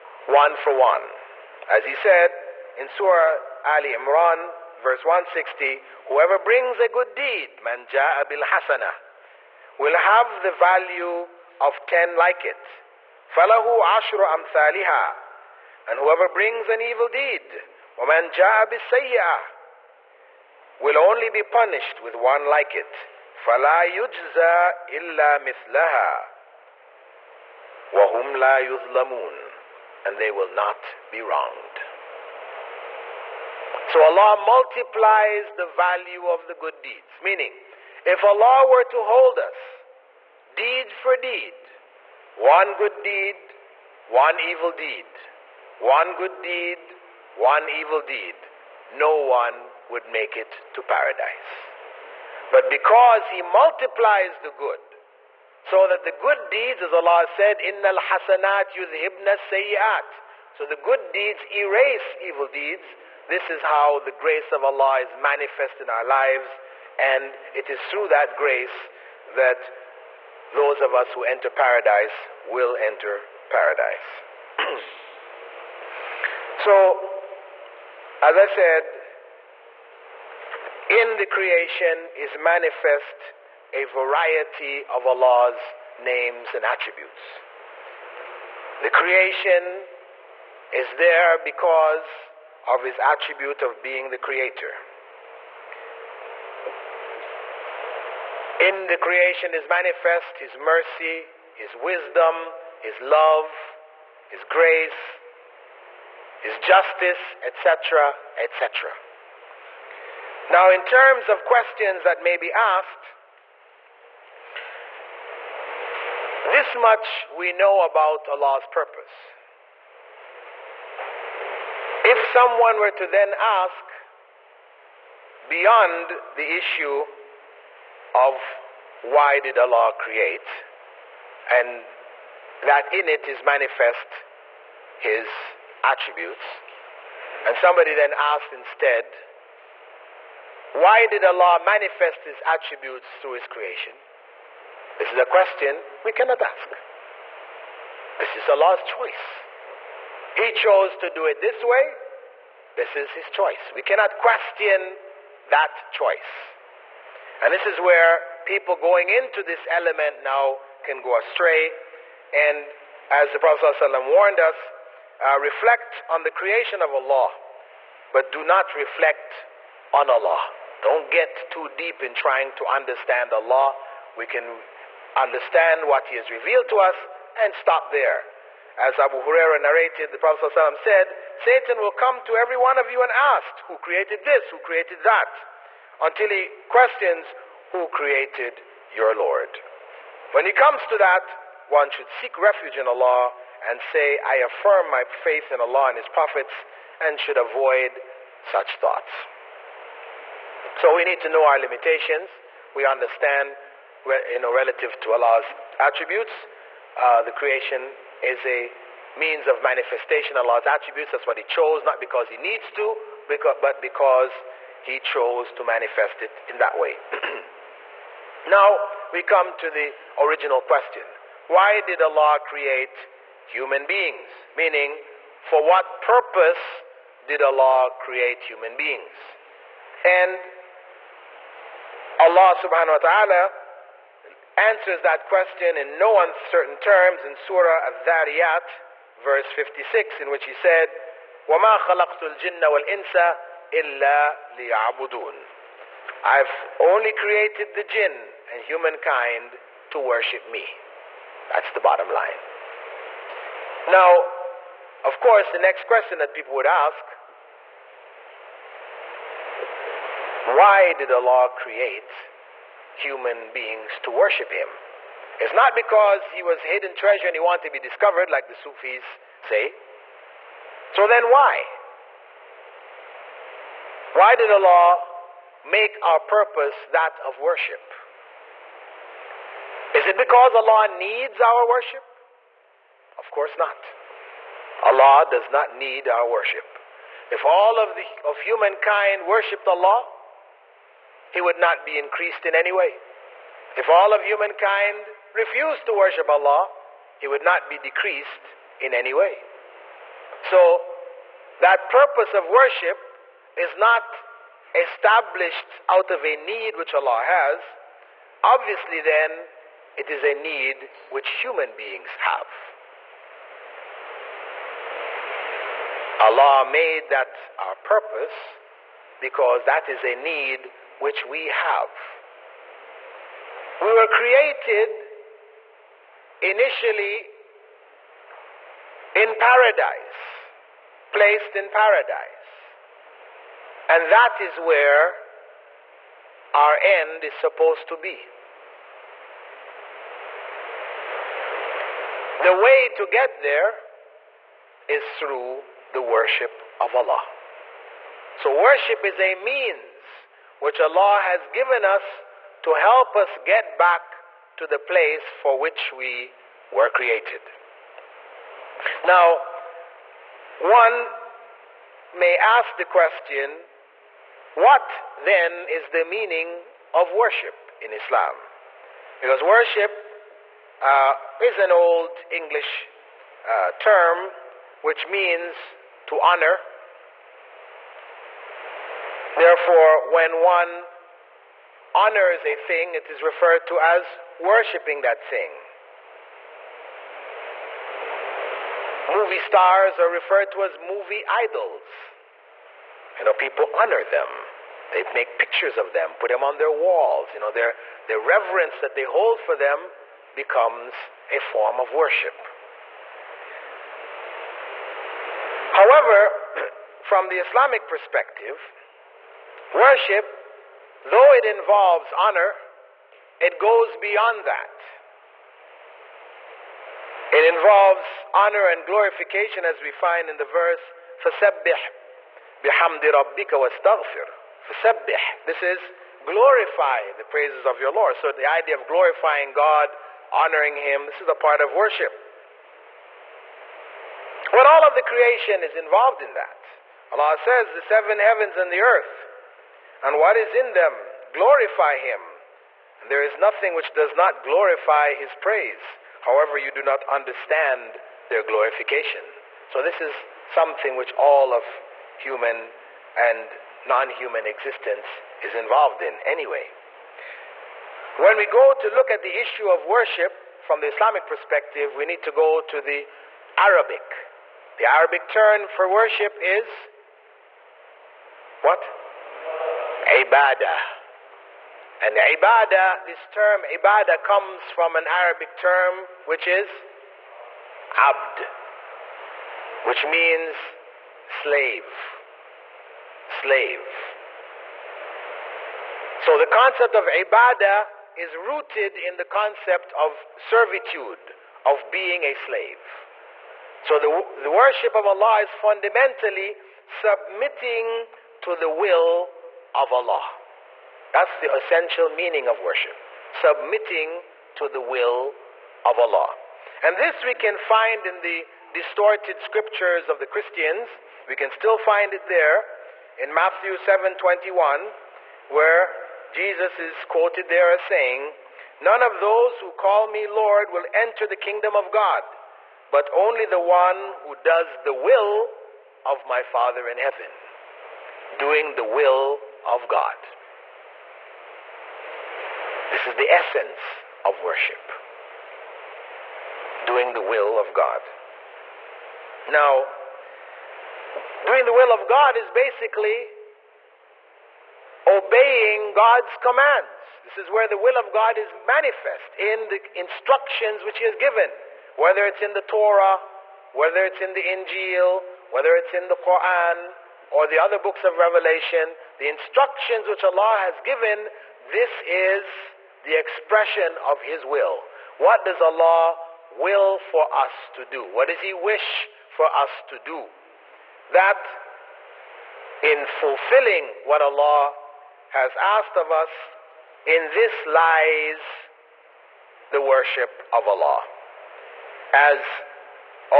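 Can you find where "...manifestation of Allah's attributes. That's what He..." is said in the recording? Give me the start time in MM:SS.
03:29.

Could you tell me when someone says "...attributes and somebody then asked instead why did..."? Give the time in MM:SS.
02:15.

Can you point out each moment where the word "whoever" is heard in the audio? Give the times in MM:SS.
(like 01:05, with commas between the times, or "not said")
00:06, 00:15.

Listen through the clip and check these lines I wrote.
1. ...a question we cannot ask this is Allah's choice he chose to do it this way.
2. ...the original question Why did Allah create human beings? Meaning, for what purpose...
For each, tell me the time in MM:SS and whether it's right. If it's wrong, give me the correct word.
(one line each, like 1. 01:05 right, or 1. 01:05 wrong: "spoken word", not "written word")
1. 02:25 right
2. 03:39 right.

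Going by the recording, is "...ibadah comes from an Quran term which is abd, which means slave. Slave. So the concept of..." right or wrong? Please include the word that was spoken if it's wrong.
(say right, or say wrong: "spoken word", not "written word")
wrong: "Arabic", not "Quran".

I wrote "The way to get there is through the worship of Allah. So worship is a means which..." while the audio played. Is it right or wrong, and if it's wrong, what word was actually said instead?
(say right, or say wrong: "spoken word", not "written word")
right.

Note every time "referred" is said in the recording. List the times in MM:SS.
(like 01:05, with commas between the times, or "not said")
06:23, 06:30.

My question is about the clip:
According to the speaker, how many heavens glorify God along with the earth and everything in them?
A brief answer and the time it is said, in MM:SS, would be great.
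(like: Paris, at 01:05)
7, at 07:17.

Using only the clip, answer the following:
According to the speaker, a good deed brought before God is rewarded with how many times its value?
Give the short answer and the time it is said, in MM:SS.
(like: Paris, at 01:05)
10, at 00:11.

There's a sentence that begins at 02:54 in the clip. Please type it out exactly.
We can understand what He has revealed to us and stop there.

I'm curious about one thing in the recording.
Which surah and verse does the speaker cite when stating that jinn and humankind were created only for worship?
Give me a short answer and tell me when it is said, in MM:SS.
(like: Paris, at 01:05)
Surah Al-Dhariyat, verse 56, at 03:57.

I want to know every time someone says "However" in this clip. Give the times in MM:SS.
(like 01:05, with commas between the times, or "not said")
06:45, 07:26.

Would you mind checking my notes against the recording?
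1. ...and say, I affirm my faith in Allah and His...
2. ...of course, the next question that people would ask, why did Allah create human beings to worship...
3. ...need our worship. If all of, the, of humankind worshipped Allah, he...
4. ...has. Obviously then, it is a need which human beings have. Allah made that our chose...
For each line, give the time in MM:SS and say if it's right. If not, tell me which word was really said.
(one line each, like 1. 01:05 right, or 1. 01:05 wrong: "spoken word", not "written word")
1. 03:13 right
2. 04:15 right
3. 04:45 right
4. 05:07 wrong: "purpose", not "chose".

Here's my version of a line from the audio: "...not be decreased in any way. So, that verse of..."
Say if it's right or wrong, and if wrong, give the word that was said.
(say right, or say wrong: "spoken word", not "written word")
wrong: "purpose", not "verse".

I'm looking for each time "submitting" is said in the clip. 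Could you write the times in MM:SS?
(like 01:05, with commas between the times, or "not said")
08:16, 08:23.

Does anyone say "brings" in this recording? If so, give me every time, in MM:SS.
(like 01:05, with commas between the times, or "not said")
00:06, 00:16.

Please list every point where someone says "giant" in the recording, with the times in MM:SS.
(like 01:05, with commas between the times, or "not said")
not said.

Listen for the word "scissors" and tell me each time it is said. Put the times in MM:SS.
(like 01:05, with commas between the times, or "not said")
not said.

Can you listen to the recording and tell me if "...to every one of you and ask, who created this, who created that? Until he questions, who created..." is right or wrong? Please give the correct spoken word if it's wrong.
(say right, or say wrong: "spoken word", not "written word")
right.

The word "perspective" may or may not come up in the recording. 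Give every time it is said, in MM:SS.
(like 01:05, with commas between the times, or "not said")
06:47, 07:41.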